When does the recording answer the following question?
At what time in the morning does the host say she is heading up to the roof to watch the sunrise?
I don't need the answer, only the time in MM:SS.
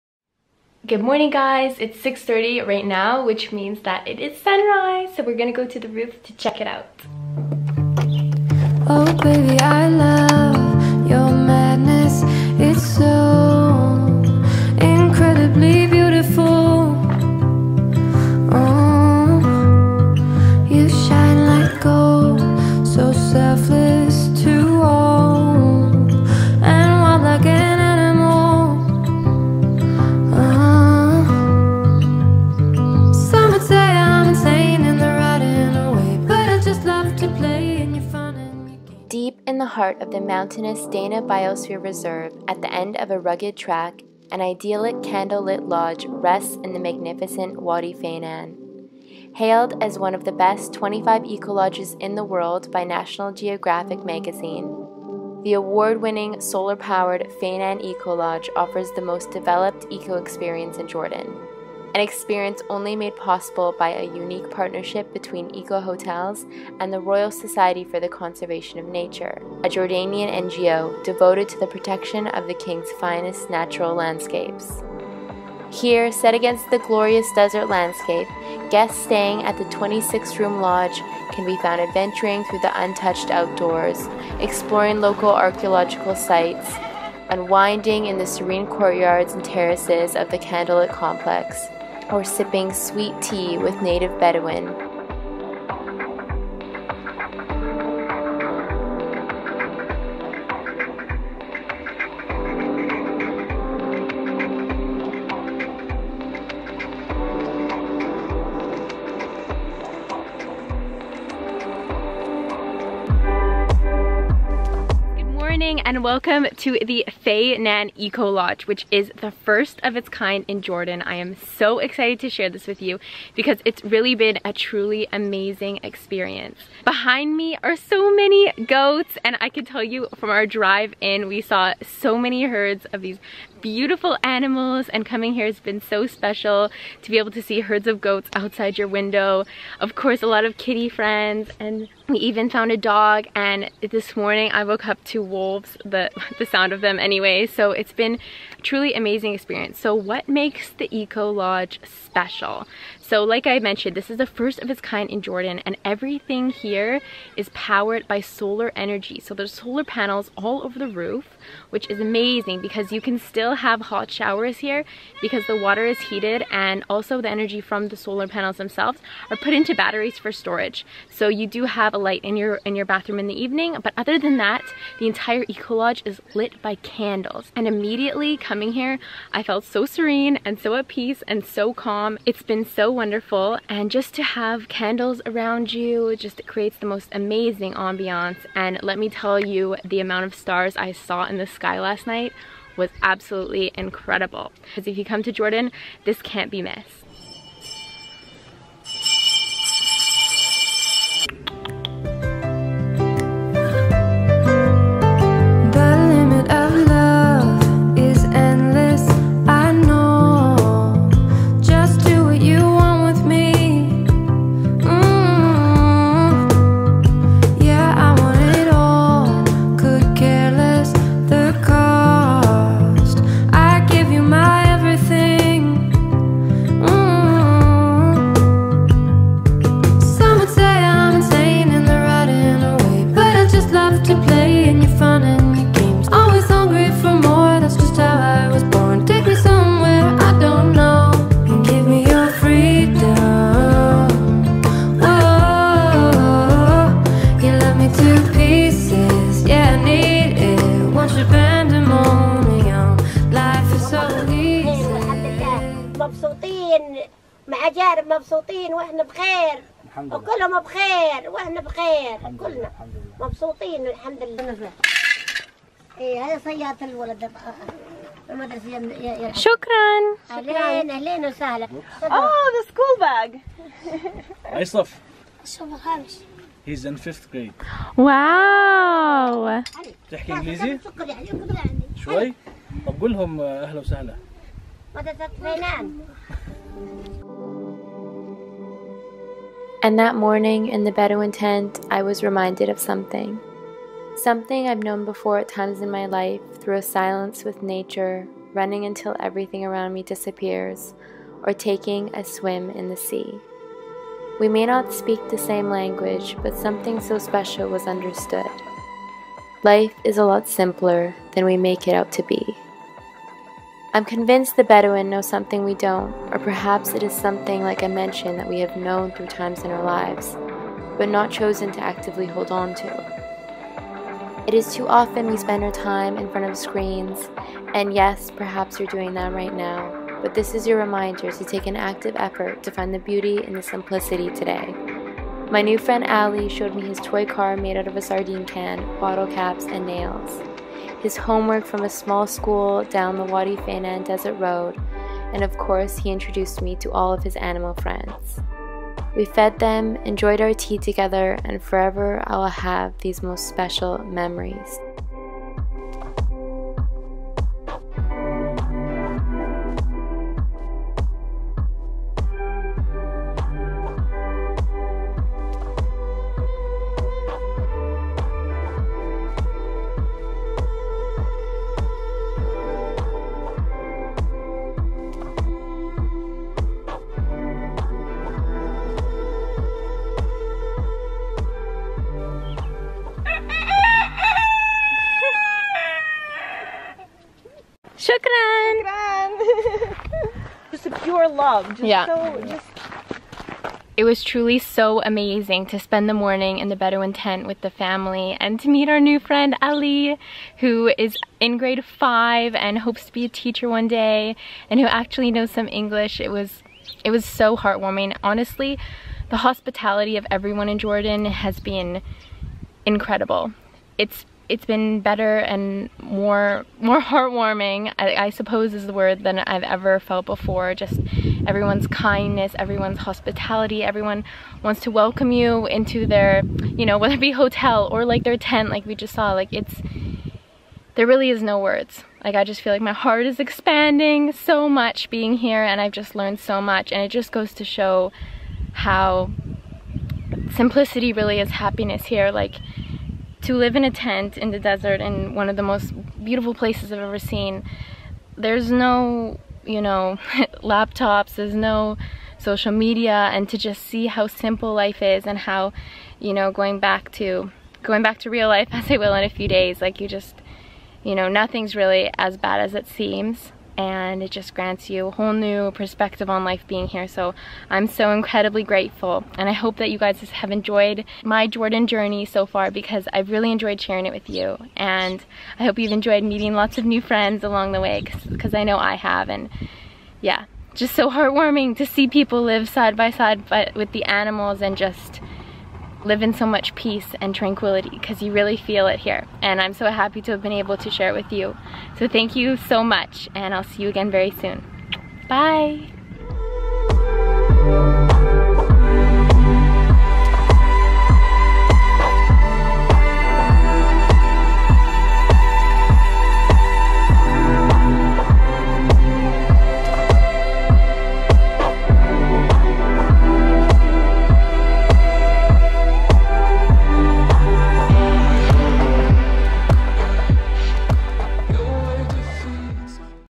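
00:01.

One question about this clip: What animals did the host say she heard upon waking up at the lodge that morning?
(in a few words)
Wolves.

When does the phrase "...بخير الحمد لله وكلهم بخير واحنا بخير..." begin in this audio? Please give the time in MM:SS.
04:19.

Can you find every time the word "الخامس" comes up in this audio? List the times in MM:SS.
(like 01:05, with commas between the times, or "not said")
04:35.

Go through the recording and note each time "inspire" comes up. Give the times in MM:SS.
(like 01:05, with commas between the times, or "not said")
not said.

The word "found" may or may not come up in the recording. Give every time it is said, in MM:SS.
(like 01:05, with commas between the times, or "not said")
01:21, 02:22.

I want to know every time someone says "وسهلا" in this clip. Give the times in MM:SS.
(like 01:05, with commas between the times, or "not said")
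04:31, 04:43.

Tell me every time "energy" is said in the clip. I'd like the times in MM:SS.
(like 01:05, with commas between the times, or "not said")
02:38, 02:47.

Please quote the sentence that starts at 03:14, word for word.
Because if you come to Jordan, this can't be missed.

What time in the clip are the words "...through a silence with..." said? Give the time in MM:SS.
04:56.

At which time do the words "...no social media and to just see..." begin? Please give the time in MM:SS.
07:31.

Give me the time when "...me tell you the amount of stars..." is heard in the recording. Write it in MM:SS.
03:08.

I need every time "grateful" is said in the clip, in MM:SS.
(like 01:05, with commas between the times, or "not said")
07:48.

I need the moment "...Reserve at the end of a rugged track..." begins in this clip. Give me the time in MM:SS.
00:41.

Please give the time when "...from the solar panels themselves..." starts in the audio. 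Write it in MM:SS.
02:47.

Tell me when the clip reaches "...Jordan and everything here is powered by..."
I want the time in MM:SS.
02:35.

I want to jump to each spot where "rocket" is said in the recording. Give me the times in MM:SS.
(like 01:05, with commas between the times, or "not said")
not said.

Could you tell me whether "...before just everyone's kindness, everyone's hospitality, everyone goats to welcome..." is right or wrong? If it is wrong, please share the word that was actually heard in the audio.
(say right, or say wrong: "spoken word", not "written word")
wrong: "wants", not "goats".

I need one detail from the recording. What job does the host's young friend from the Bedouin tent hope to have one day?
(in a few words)
Teacher.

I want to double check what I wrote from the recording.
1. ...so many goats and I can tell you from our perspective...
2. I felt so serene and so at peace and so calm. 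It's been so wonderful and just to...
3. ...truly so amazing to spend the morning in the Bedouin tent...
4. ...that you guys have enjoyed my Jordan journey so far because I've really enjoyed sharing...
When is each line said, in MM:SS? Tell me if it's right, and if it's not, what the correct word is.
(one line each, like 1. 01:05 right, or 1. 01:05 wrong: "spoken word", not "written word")
1. 02:07 wrong: "drive", not "perspective"
2. 02:59 right
3. 06:34 right
4. 07:49 right.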